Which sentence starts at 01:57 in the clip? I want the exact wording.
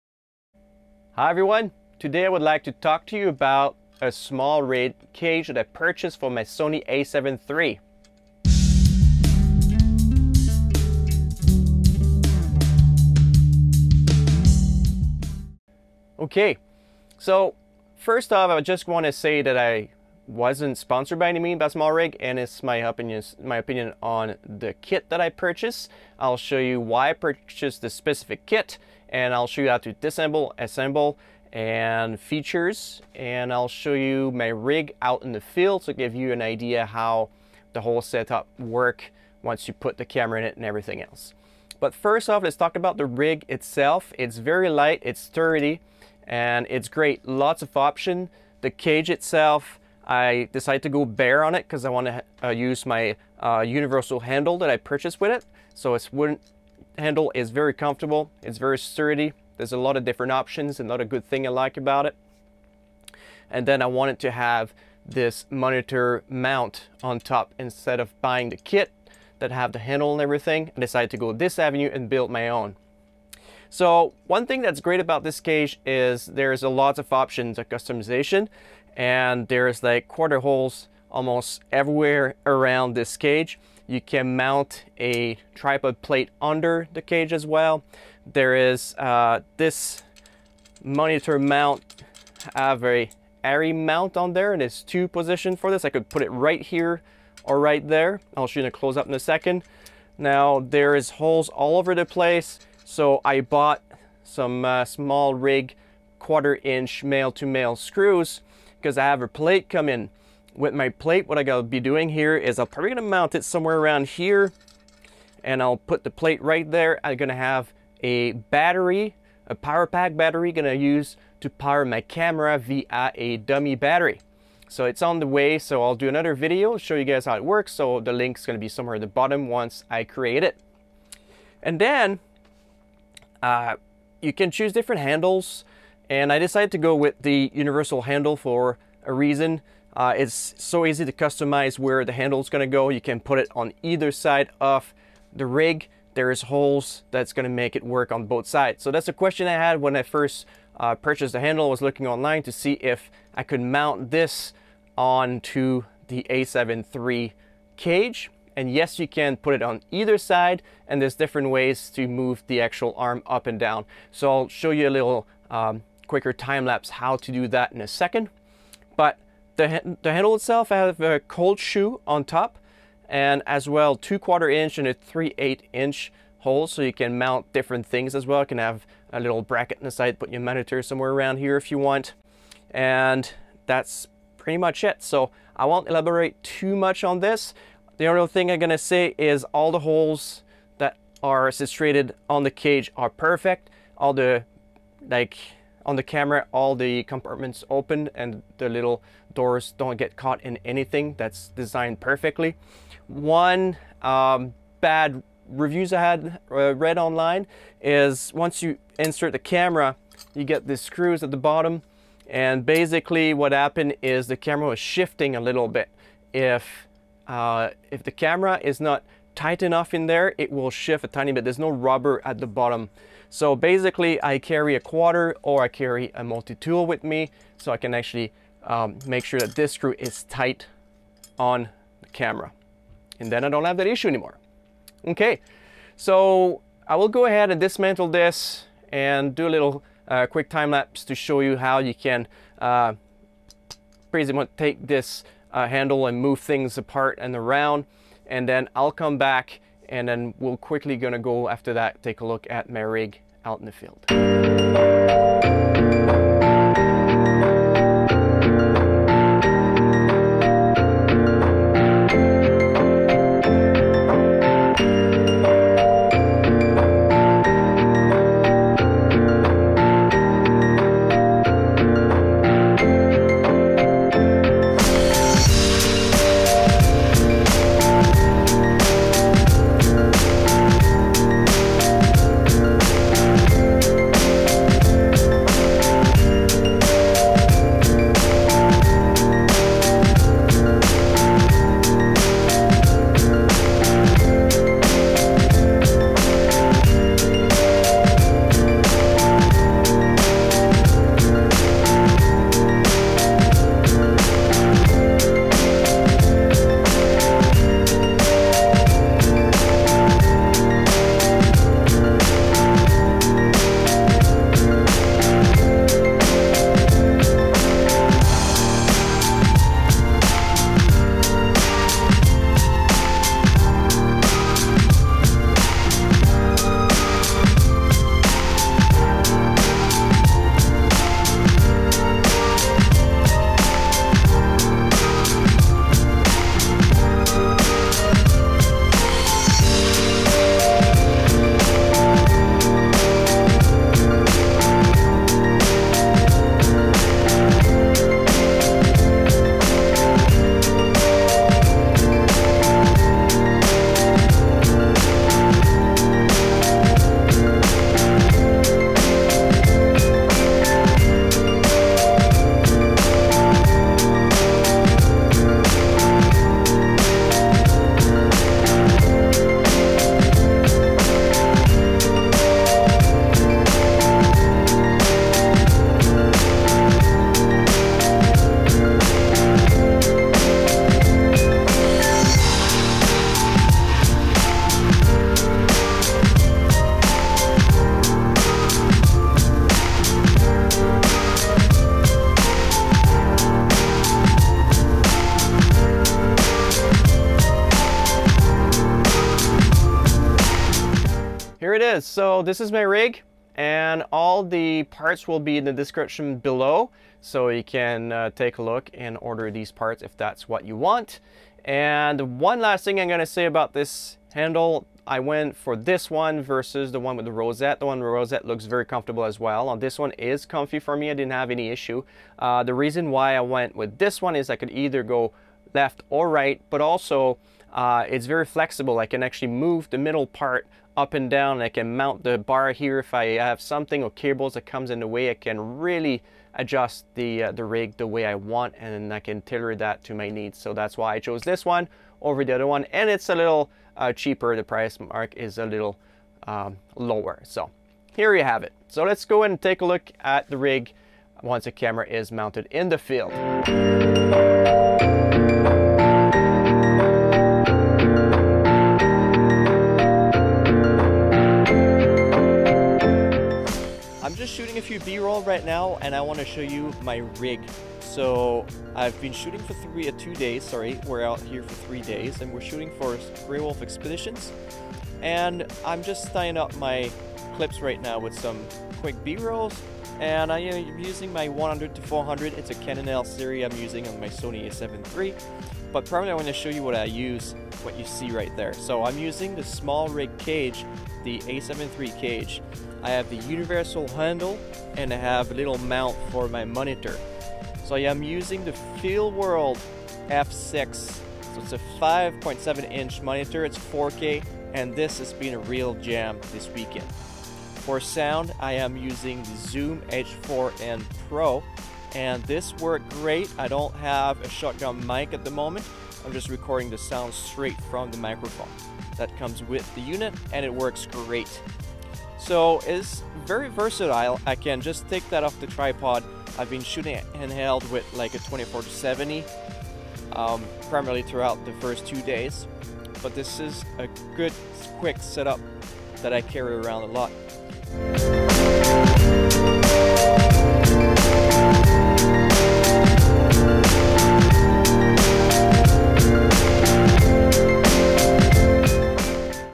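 I'm gonna have a battery, a power pack battery, gonna use to power my camera via a dummy battery.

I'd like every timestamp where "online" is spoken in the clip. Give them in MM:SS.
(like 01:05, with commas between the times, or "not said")
02:32, 03:26.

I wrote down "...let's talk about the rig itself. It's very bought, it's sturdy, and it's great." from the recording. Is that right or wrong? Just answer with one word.
wrong.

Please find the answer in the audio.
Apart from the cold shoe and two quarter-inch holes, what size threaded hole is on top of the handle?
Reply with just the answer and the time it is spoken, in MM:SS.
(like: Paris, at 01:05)
3/8 inch, at 02:54.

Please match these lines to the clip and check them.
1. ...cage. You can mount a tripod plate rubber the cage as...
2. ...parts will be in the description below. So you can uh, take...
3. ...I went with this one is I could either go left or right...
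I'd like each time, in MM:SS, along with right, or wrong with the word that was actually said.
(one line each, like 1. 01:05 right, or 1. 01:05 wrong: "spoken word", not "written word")
1. 01:23 wrong: "under", not "rubber"
2. 06:44 right
3. 07:03 right.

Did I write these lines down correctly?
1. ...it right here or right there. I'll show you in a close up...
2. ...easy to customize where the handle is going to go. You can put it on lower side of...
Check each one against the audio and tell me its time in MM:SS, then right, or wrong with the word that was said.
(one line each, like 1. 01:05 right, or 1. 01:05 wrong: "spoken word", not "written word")
1. 01:36 right
2. 02:20 wrong: "either", not "lower".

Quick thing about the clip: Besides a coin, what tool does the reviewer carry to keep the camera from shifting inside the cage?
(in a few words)
multi-tool.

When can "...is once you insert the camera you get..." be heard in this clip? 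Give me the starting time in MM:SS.
03:27.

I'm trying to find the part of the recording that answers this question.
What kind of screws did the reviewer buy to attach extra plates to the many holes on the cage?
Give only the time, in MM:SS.
01:46.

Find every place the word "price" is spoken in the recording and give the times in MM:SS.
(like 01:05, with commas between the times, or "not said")
07:24.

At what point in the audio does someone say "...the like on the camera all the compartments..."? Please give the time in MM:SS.
03:14.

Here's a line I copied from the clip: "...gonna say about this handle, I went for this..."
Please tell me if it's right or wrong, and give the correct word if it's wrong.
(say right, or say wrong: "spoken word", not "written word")
right.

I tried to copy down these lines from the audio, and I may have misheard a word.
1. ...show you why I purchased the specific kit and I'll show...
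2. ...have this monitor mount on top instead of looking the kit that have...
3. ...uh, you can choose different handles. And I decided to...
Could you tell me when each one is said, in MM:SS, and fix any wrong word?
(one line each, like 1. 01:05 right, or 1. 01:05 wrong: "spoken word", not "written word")
1. 00:26 right
2. 01:04 wrong: "buying", not "looking"
3. 02:13 right.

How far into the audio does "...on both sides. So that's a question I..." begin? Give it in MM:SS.
02:28.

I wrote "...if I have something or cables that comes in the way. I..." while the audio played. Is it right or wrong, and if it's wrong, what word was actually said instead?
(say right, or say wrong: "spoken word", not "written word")
right.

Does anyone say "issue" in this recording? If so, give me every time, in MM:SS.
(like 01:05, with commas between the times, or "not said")
03:53, 07:01.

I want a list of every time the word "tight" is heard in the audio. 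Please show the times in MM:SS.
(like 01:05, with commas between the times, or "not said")
03:39, 03:50.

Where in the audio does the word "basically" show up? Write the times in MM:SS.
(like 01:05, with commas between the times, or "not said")
03:32, 03:43.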